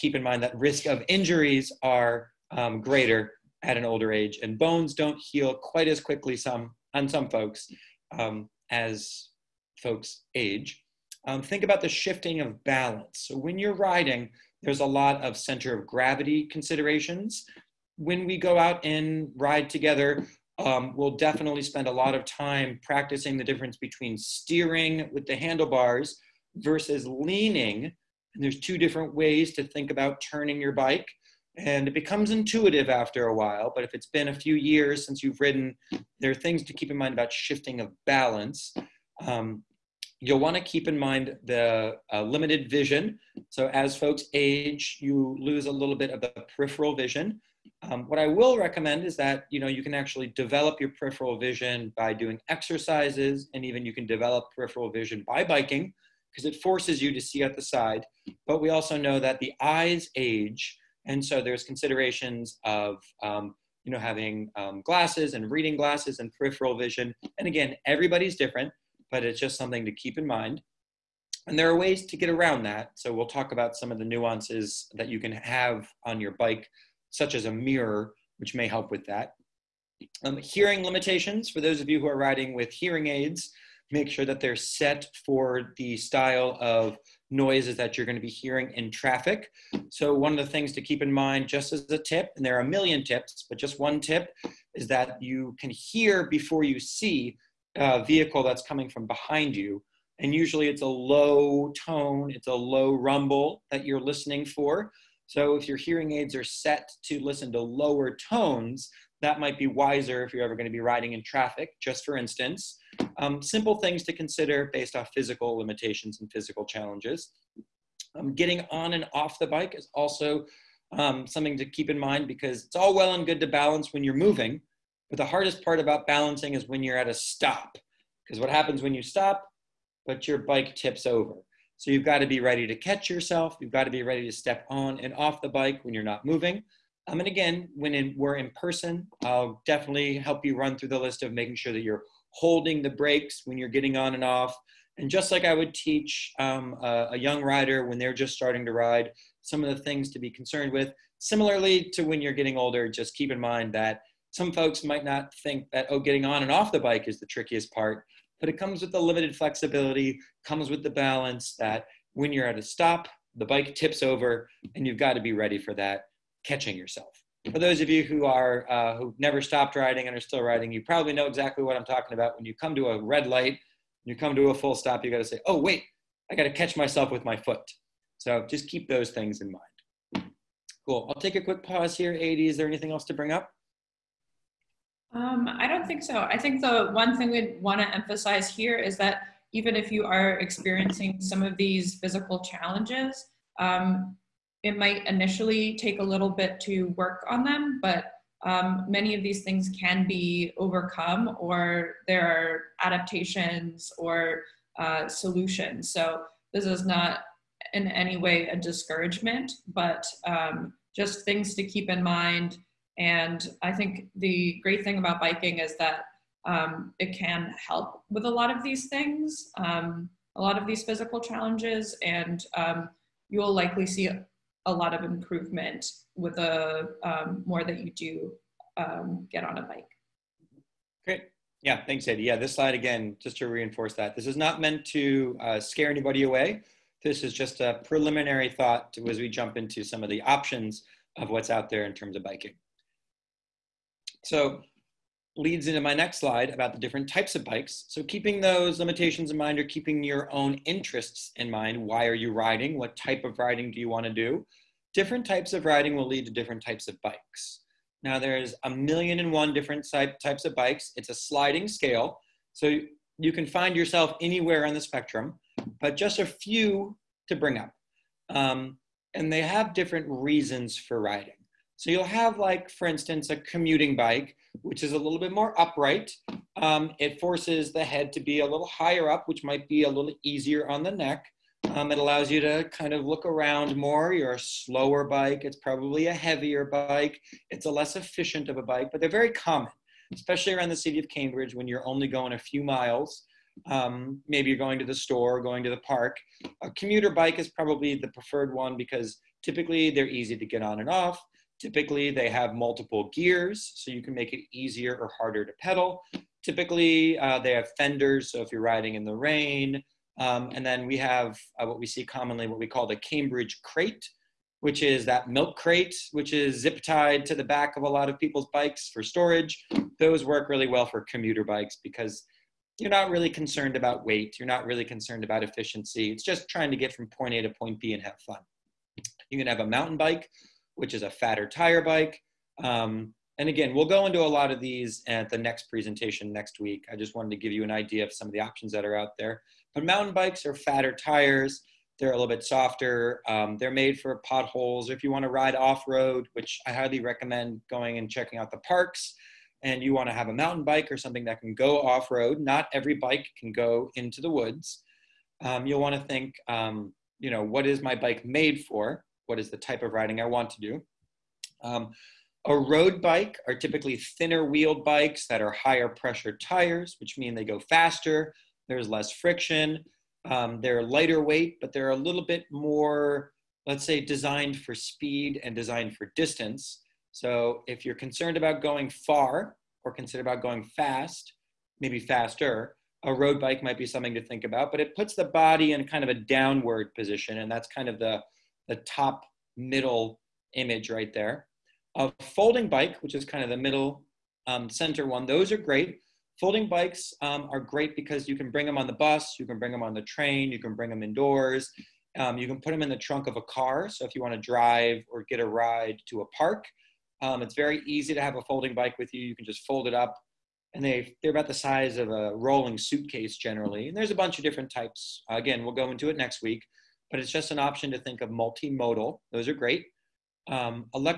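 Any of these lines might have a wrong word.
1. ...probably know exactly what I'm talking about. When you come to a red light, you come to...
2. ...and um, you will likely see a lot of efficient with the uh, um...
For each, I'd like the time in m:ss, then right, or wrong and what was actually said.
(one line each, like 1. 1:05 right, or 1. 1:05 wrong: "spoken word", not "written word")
1. 2:50 right
2. 3:42 wrong: "improvement", not "efficient".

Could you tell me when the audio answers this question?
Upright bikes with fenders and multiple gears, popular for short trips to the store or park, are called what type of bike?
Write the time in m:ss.
4:33.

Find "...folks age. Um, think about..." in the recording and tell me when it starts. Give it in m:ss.
0:09.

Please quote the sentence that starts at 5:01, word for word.
Typically, they have multiple gears, so you can make it easier or harder to pedal.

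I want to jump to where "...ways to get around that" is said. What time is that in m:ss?
1:11.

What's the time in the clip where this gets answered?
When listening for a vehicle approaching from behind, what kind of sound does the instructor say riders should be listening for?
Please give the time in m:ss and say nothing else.
1:42.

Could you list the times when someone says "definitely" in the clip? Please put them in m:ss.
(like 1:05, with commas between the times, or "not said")
0:21, 2:19.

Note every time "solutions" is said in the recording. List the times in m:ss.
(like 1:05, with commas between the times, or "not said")
3:25.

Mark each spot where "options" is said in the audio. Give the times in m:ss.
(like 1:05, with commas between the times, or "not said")
4:00, 5:38, 6:57.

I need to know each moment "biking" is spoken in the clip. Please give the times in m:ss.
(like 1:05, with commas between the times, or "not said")
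0:55, 3:35, 4:02.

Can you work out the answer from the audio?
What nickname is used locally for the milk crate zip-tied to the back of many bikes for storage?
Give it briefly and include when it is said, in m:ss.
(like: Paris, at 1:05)
Cambridge crate, at 5:12.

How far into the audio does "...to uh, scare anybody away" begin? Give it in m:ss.
3:54.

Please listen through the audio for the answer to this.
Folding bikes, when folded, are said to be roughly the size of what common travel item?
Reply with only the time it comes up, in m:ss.
6:52.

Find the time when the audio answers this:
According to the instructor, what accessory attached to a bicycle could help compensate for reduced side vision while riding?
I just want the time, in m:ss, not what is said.
1:17.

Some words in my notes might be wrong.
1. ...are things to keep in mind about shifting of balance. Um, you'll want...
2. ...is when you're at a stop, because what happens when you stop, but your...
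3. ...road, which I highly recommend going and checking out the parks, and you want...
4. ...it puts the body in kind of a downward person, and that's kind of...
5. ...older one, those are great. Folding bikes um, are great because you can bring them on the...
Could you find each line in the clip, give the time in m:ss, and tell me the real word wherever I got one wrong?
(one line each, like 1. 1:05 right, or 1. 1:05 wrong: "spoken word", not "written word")
1. 0:36 right
2. 2:06 right
3. 5:45 right
4. 6:24 wrong: "position", not "person"
5. 6:34 wrong: "center", not "older".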